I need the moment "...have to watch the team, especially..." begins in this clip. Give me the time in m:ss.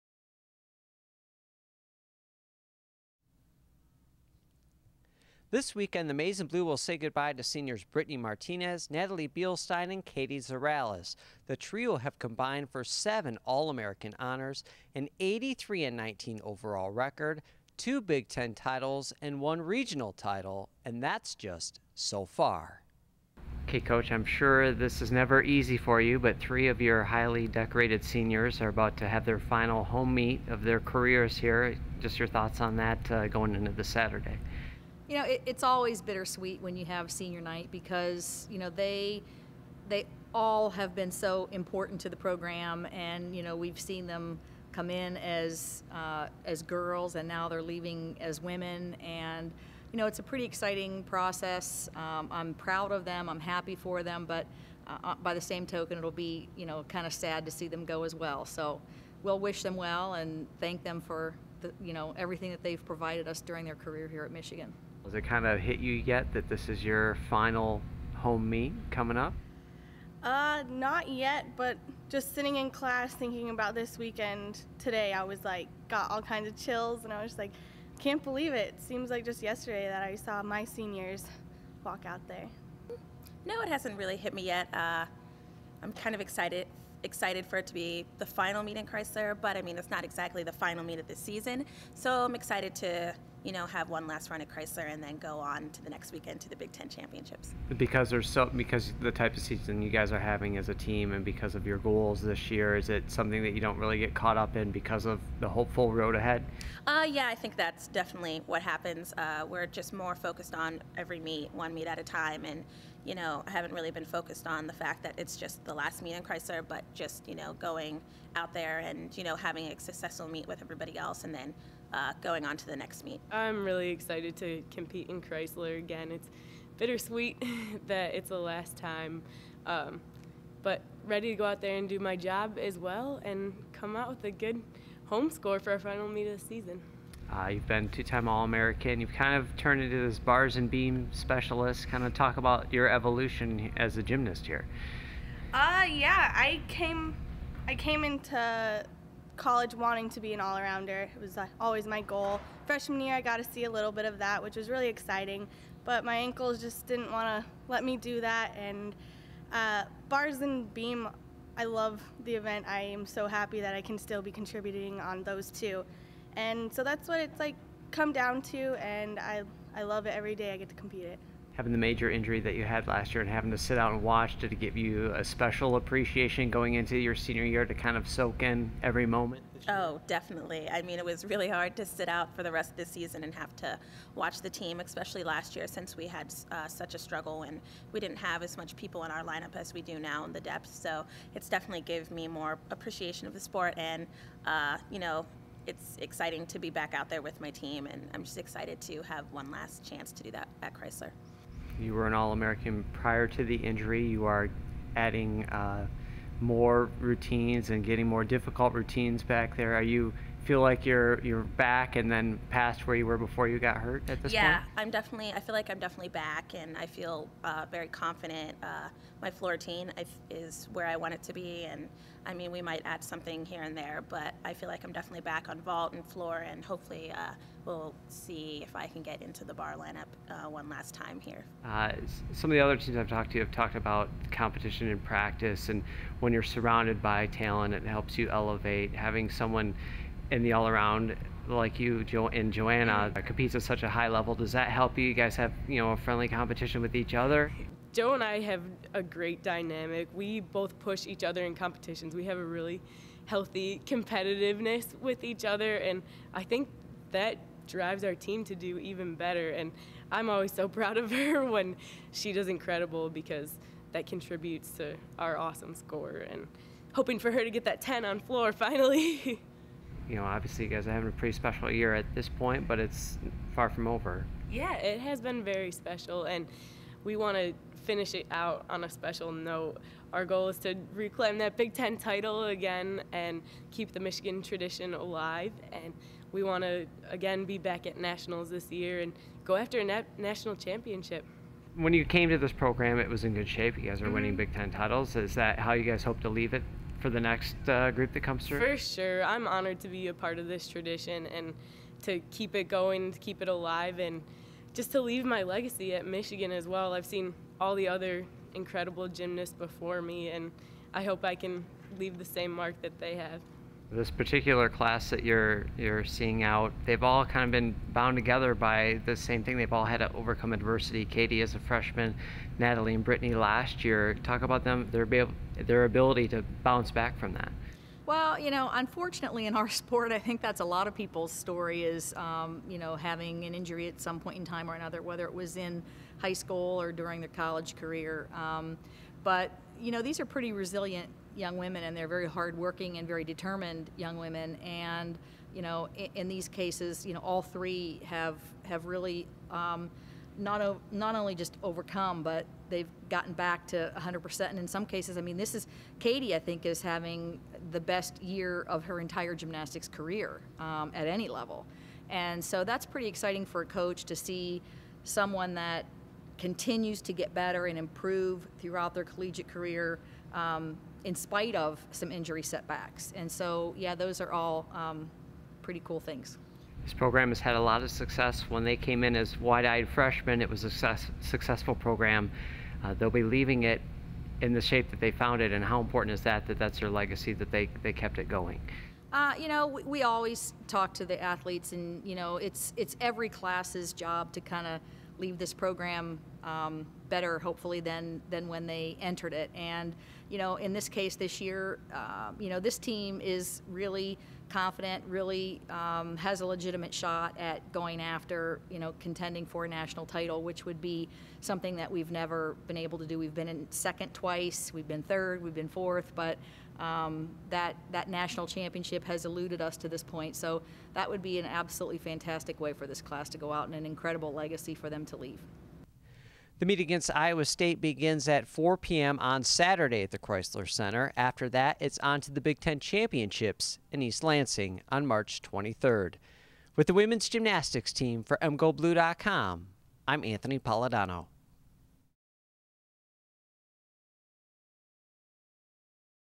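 3:03.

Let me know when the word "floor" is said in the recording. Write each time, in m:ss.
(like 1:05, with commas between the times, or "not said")
3:39, 3:46, 4:28.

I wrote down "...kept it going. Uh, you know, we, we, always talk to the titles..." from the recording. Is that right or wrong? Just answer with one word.
wrong.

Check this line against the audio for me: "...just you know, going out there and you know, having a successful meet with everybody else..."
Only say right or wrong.
right.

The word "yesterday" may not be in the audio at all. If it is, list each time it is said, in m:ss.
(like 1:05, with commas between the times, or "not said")
1:19.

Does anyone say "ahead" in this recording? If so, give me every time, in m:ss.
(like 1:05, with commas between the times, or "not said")
1:46.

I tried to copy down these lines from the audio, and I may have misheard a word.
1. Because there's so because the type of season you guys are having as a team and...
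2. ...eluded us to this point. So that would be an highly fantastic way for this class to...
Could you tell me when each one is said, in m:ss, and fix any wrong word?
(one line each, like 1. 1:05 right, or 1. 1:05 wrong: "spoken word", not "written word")
1. 1:37 right
2. 6:59 wrong: "absolutely", not "highly".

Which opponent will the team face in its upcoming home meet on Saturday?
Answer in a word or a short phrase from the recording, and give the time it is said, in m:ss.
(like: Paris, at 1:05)
Iowa State, at 7:07.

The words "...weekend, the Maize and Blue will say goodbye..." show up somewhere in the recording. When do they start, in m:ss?
0:05.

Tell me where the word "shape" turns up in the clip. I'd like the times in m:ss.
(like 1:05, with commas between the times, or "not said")
4:53, 6:24.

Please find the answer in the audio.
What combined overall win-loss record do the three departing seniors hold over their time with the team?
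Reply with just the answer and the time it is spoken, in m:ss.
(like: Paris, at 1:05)
83 and 19, at 0:15.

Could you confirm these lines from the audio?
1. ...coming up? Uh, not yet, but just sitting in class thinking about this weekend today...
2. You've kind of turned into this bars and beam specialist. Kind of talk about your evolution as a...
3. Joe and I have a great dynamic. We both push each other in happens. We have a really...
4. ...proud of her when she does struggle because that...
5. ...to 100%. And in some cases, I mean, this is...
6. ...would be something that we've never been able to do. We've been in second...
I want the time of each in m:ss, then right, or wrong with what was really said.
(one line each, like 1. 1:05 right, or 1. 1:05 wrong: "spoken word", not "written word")
1. 1:08 right
2. 2:18 right
3. 4:07 wrong: "competitions", not "happens"
4. 4:20 wrong: "incredible", not "struggle"
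5. 5:53 right
6. 6:50 right.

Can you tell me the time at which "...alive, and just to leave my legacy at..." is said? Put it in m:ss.
5:03.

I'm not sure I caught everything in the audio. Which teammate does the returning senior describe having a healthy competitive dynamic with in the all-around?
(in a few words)
Joanna.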